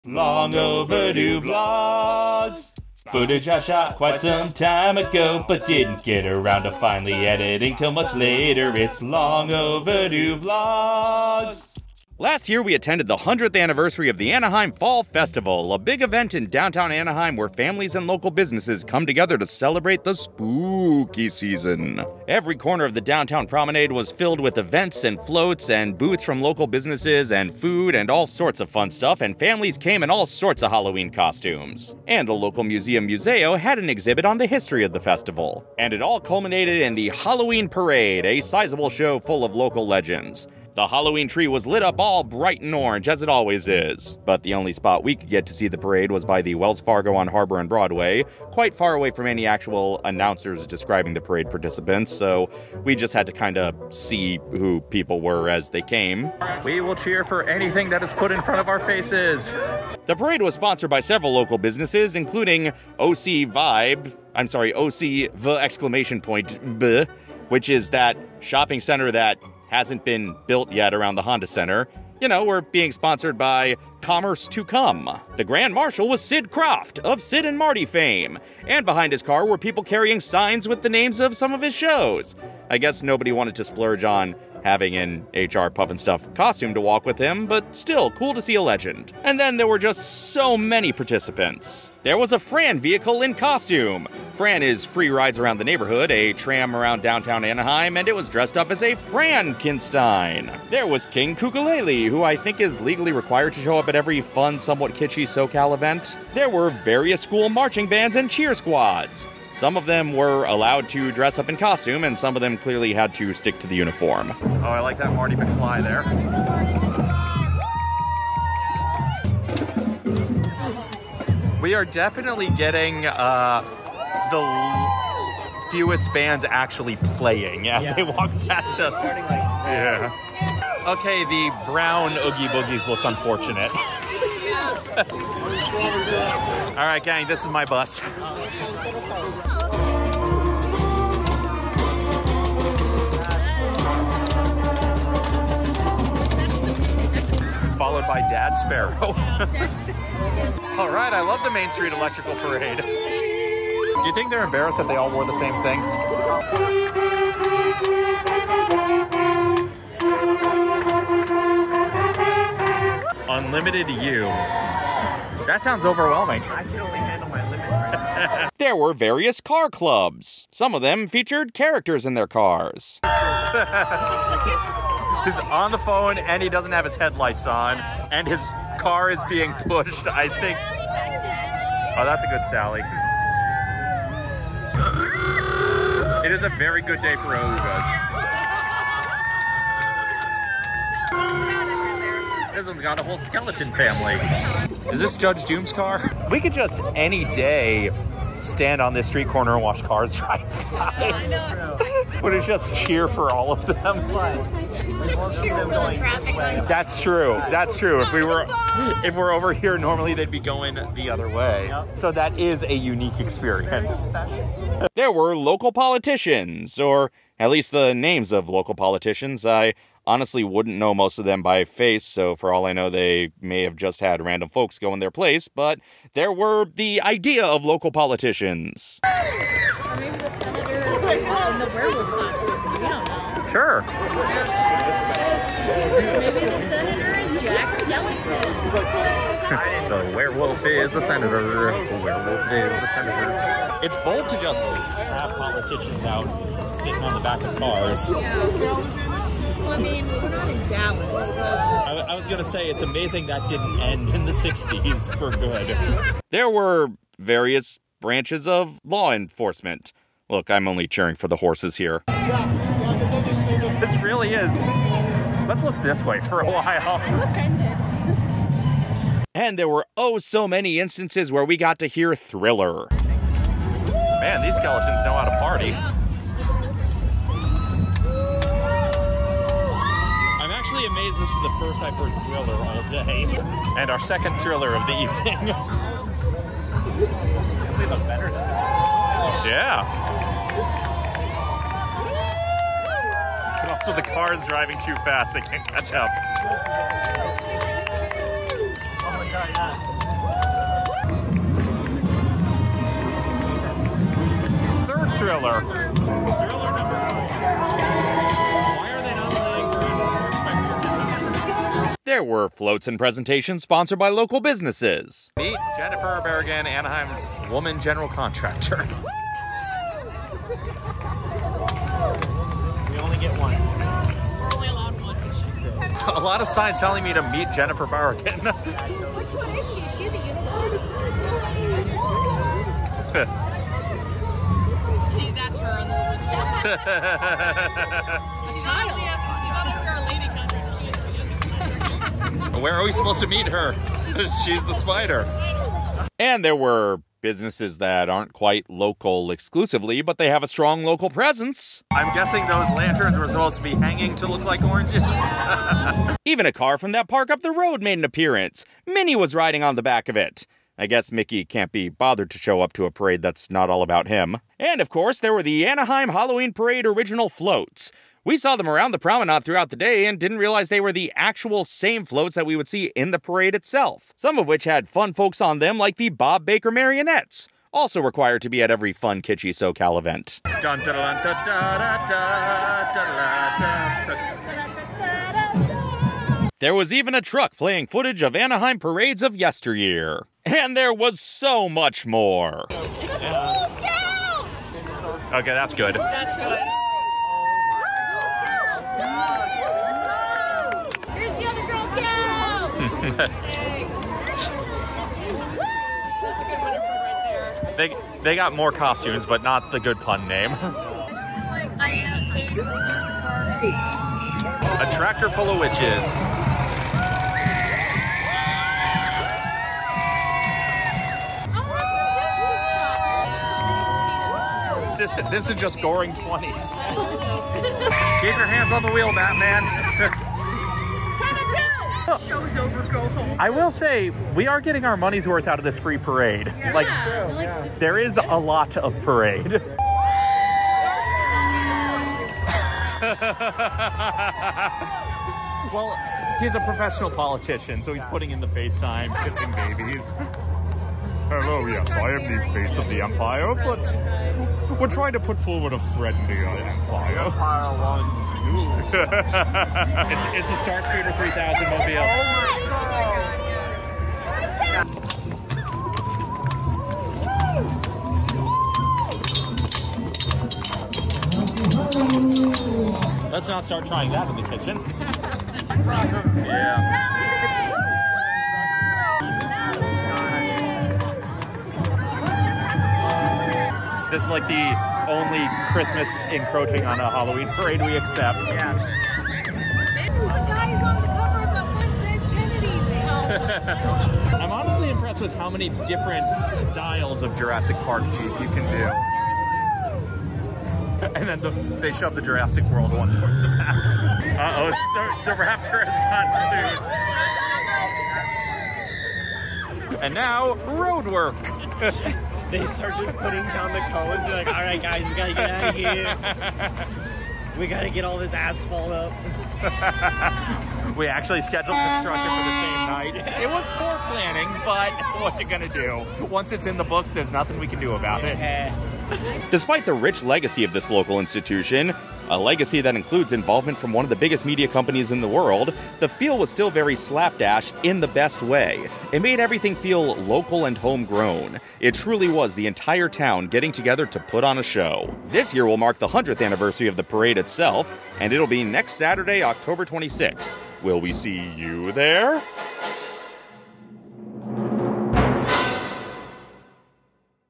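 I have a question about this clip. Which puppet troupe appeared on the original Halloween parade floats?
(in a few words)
Bob Baker marionettes.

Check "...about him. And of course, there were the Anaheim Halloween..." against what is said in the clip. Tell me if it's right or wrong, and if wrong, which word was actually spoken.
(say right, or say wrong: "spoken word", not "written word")
right.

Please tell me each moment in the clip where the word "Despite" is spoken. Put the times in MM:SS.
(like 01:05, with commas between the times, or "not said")
08:49.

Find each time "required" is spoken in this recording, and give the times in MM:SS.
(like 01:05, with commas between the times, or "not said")
01:43, 06:17.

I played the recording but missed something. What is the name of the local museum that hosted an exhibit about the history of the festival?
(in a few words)
Muzeo.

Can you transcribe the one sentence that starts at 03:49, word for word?
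Or maybe the senator in the werewolf costume.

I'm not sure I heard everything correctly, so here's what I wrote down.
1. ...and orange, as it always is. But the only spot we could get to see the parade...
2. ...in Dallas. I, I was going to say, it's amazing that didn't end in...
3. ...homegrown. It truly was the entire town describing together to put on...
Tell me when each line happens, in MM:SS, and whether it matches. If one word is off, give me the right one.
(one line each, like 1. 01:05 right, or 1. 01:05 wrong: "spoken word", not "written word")
1. 00:42 right
2. 04:10 right
3. 09:00 wrong: "getting", not "describing".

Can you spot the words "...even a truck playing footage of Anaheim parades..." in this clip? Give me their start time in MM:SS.
06:26.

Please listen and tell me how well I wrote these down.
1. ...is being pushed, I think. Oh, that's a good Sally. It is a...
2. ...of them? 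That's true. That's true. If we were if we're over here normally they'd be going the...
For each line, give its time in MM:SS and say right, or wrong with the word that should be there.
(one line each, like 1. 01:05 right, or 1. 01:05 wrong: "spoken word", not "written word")
1. 02:59 right
2. 03:23 right.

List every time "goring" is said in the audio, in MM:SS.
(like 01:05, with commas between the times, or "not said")
07:05.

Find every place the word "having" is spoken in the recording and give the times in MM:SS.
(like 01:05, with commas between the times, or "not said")
01:24.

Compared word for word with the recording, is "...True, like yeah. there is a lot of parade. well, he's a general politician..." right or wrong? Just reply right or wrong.
wrong.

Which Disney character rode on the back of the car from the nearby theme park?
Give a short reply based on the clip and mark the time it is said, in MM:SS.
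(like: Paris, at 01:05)
Minnie, at 05:58.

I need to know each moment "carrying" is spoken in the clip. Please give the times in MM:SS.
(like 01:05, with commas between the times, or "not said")
01:19.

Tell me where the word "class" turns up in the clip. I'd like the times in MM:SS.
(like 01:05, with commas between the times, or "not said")
not said.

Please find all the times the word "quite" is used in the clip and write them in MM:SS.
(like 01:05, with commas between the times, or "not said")
00:03, 00:48, 05:48.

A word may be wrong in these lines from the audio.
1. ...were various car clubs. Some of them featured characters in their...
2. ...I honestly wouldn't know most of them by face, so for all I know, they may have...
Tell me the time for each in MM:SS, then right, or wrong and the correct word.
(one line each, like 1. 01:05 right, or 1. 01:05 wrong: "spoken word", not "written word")
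1. 02:48 right
2. 03:39 right.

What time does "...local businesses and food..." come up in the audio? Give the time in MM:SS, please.
00:26.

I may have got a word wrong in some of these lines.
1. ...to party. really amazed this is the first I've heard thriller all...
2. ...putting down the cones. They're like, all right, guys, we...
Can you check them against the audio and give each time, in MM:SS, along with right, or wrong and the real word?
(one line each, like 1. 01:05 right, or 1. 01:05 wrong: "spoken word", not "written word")
1. 04:35 right
2. 08:33 right.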